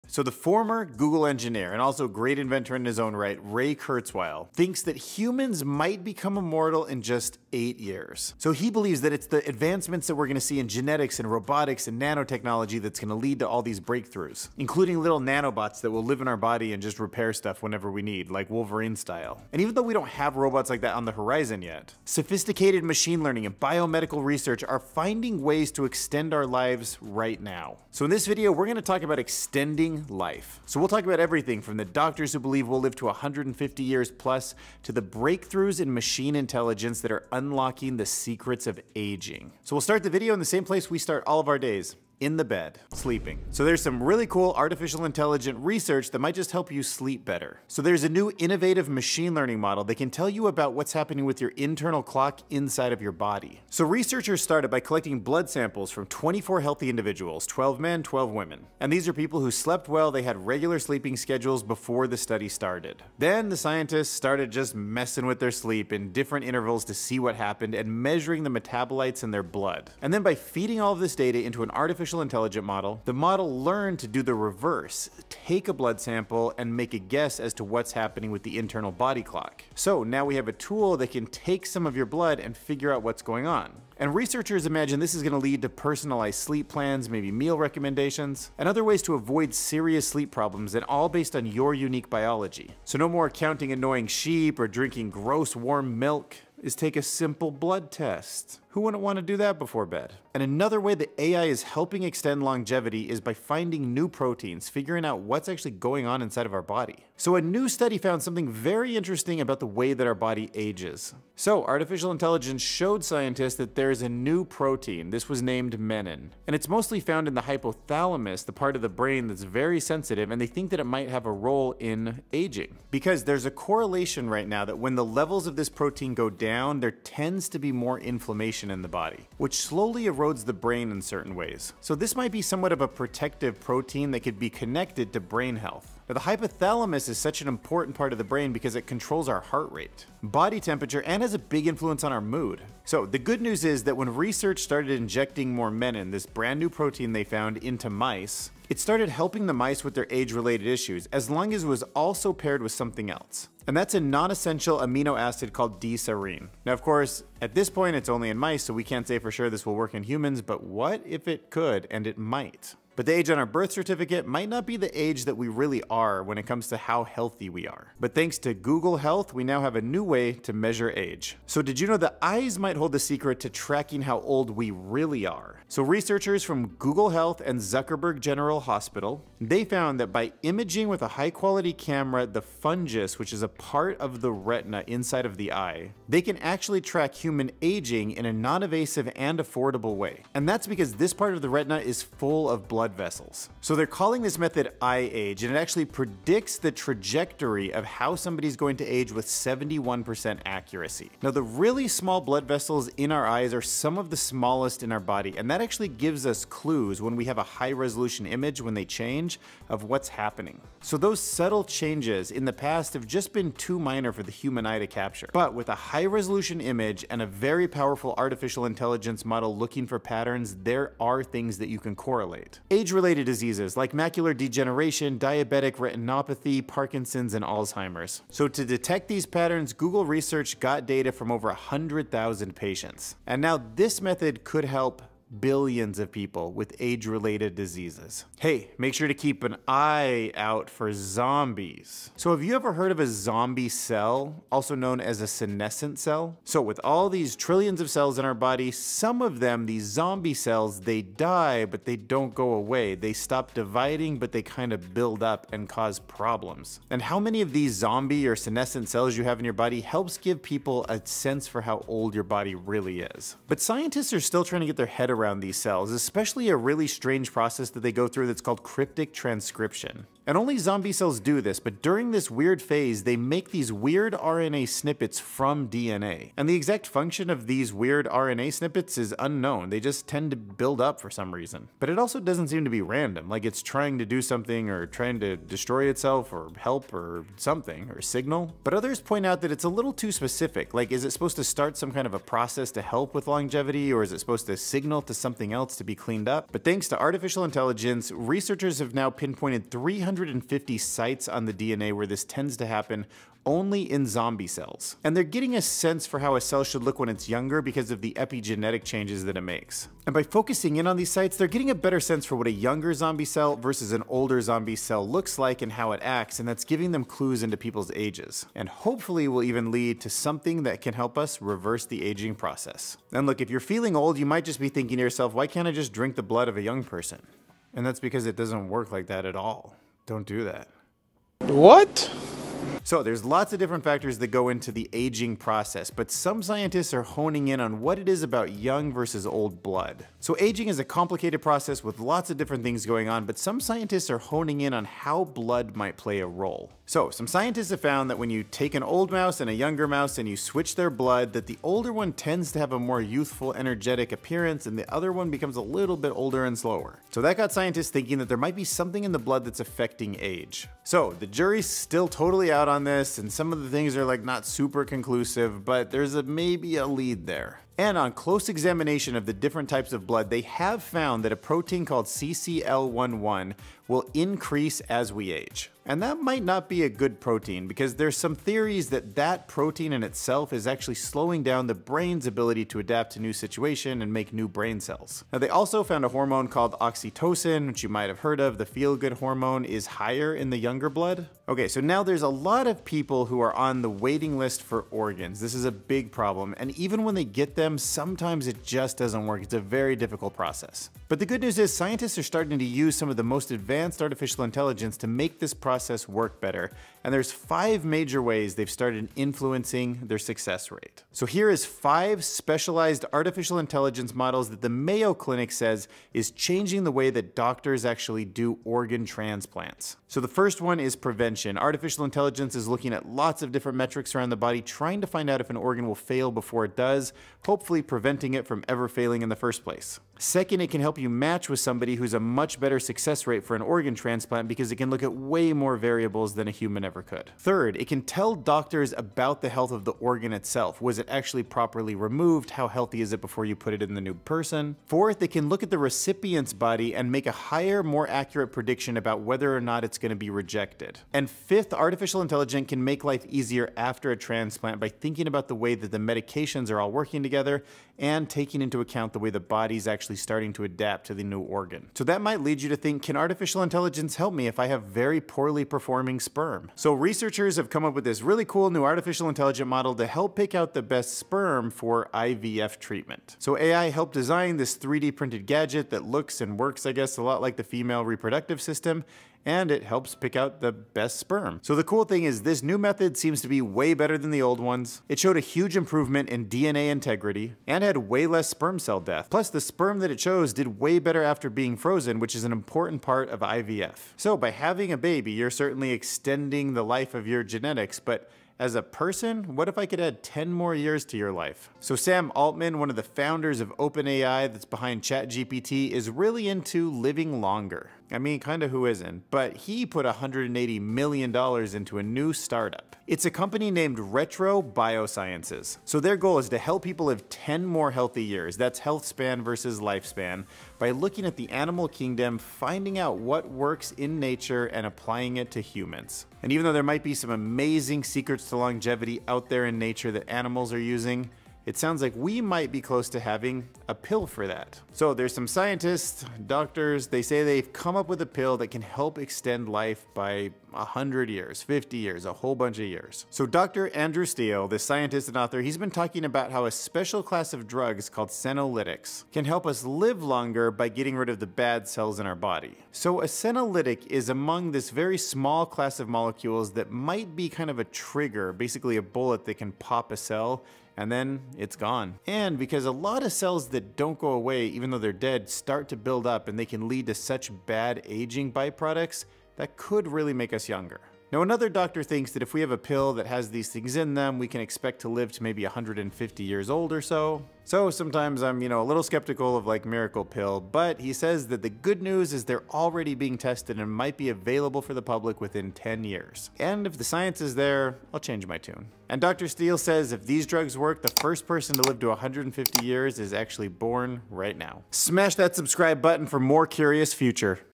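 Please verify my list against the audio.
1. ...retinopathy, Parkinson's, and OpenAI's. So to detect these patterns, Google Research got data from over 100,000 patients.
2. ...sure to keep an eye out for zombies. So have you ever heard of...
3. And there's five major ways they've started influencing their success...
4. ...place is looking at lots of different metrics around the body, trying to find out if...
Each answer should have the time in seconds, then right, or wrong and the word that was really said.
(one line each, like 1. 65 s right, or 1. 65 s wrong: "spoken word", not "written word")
1. 225 s wrong: "Alzheimer", not "OpenAI"
2. 238 s right
3. 407 s right
4. 422 s wrong: "intelligence", not "place".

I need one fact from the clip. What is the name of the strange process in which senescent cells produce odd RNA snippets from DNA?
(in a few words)
cryptic transcription.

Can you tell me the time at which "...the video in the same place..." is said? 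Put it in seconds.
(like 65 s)
40 s.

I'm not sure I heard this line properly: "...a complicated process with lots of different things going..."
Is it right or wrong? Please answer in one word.
right.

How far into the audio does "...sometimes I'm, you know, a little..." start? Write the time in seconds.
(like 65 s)
577 s.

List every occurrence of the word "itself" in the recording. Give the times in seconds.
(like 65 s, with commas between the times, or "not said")
285 s, 380 s, 440 s.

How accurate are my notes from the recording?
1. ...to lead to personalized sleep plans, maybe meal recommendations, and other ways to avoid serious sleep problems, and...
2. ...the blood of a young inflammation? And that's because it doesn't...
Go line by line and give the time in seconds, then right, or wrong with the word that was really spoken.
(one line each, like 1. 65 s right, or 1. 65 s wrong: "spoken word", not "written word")
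1. 85 s right
2. 326 s wrong: "person", not "inflammation".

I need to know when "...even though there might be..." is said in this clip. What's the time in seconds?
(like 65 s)
526 s.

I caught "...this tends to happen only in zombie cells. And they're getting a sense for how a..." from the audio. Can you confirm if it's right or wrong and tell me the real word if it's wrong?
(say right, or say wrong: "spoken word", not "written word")
right.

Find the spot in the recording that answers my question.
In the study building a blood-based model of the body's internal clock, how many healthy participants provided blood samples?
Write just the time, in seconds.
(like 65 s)
56 s.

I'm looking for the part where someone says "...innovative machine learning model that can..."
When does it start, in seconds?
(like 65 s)
48 s.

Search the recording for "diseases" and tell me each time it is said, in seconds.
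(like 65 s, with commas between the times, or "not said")
223 s, 237 s.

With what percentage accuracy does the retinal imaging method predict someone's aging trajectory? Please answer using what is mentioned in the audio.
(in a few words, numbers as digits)
71%.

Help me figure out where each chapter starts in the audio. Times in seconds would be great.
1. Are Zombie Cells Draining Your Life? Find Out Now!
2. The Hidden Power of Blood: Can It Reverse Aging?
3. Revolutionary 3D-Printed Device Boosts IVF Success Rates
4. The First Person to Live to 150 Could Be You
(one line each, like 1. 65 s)
1. 241 s
2. 332 s
3. 466 s
4. 534 s.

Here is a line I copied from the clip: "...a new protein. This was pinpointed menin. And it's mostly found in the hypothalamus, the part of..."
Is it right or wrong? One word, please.
wrong.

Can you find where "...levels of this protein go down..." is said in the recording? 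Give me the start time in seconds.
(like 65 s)
125 s.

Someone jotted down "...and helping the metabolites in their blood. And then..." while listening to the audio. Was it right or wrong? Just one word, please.
wrong.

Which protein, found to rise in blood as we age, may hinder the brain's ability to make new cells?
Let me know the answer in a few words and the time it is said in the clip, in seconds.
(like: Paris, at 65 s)
CCL11, at 372 s.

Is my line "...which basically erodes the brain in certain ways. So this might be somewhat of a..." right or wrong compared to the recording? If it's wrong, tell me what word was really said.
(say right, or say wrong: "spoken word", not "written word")
wrong: "slowly", not "basically".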